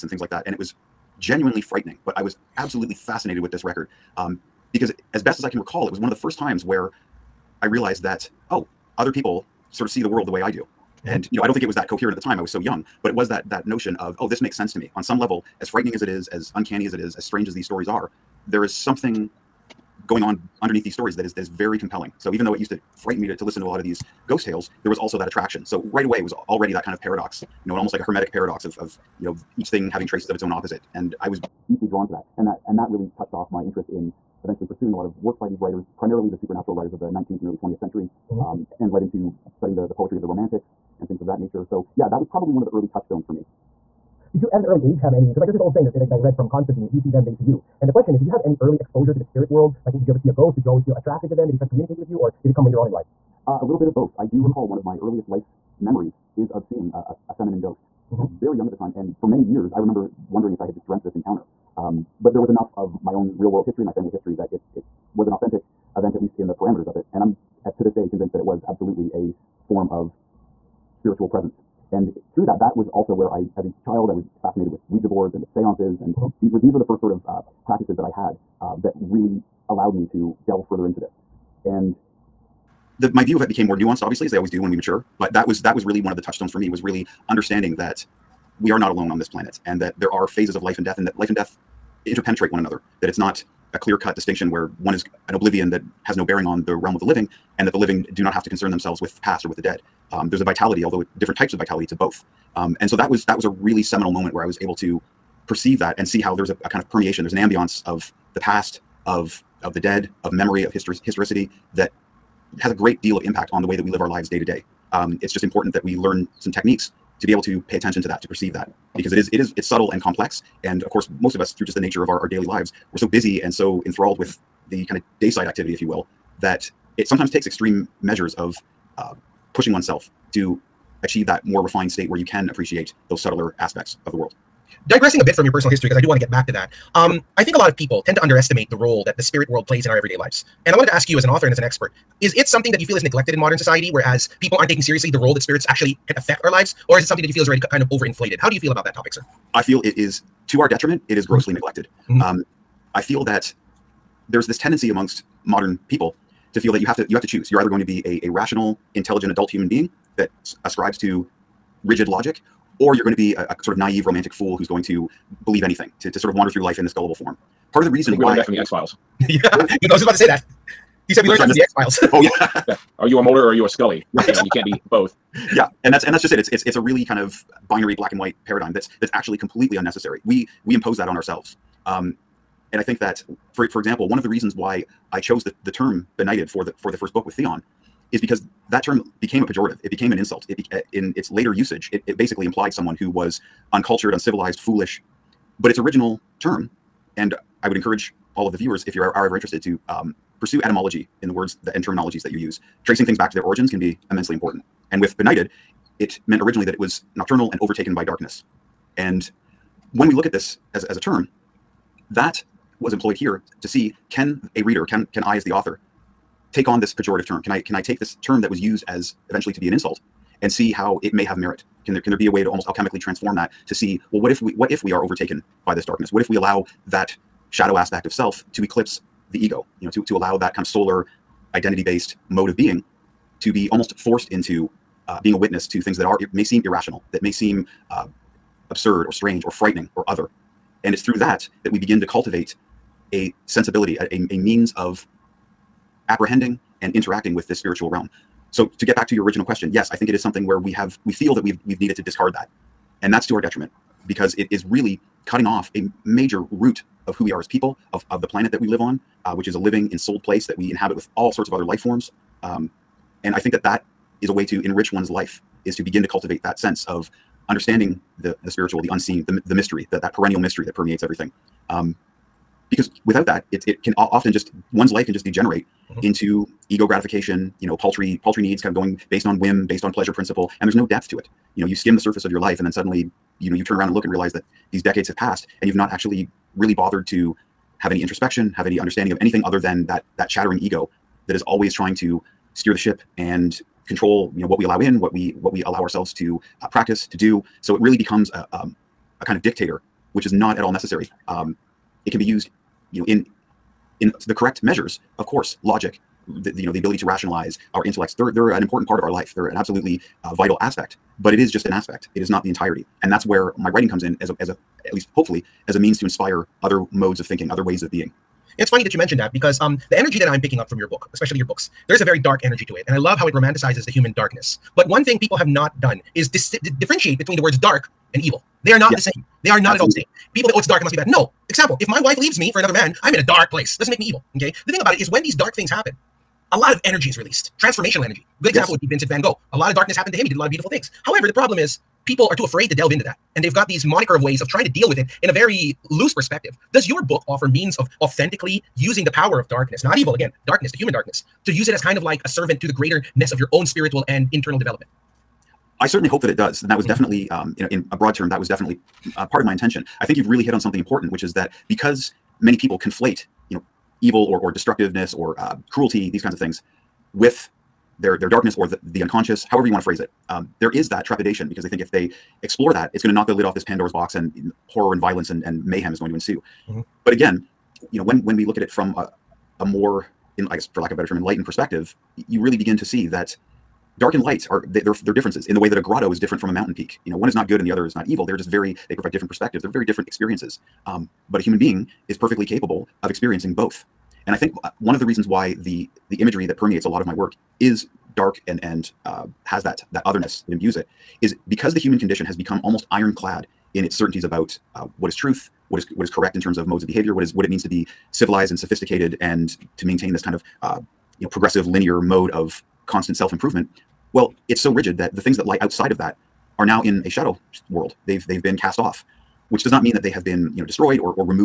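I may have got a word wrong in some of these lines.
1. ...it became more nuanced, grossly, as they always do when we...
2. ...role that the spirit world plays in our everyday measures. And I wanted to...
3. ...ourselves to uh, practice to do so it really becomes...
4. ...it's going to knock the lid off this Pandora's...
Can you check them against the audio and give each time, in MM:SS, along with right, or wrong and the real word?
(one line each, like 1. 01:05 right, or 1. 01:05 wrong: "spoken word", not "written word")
1. 01:23 wrong: "obviously", not "grossly"
2. 02:18 wrong: "lives", not "measures"
3. 04:55 right
4. 06:12 right.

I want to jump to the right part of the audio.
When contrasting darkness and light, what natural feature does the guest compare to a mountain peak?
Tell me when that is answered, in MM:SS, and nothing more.
06:25.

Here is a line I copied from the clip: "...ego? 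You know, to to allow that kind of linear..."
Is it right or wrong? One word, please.
wrong.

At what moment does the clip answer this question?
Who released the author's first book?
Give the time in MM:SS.
03:07.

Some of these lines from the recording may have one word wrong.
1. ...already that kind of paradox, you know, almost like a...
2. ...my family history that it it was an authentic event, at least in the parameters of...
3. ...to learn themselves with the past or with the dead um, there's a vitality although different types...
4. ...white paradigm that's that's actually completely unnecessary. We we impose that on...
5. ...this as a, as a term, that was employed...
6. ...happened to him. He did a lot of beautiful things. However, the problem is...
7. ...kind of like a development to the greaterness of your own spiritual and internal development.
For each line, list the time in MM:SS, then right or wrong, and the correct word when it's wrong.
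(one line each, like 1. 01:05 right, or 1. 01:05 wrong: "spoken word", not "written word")
1. 00:26 right
2. 01:03 right
3. 01:38 wrong: "concern", not "learn"
4. 02:58 right
5. 03:30 right
6. 05:39 right
7. 05:51 wrong: "servant", not "development".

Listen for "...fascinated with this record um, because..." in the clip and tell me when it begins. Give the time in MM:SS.
00:02.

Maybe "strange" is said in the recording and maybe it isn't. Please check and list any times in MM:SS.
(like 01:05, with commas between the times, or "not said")
00:17, 03:59.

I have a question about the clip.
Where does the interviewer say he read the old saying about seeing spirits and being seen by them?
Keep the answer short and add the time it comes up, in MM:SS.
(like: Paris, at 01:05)
Constantine, at 00:46.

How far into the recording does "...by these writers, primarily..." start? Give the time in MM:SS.
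00:35.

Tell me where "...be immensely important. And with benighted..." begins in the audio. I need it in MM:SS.
03:23.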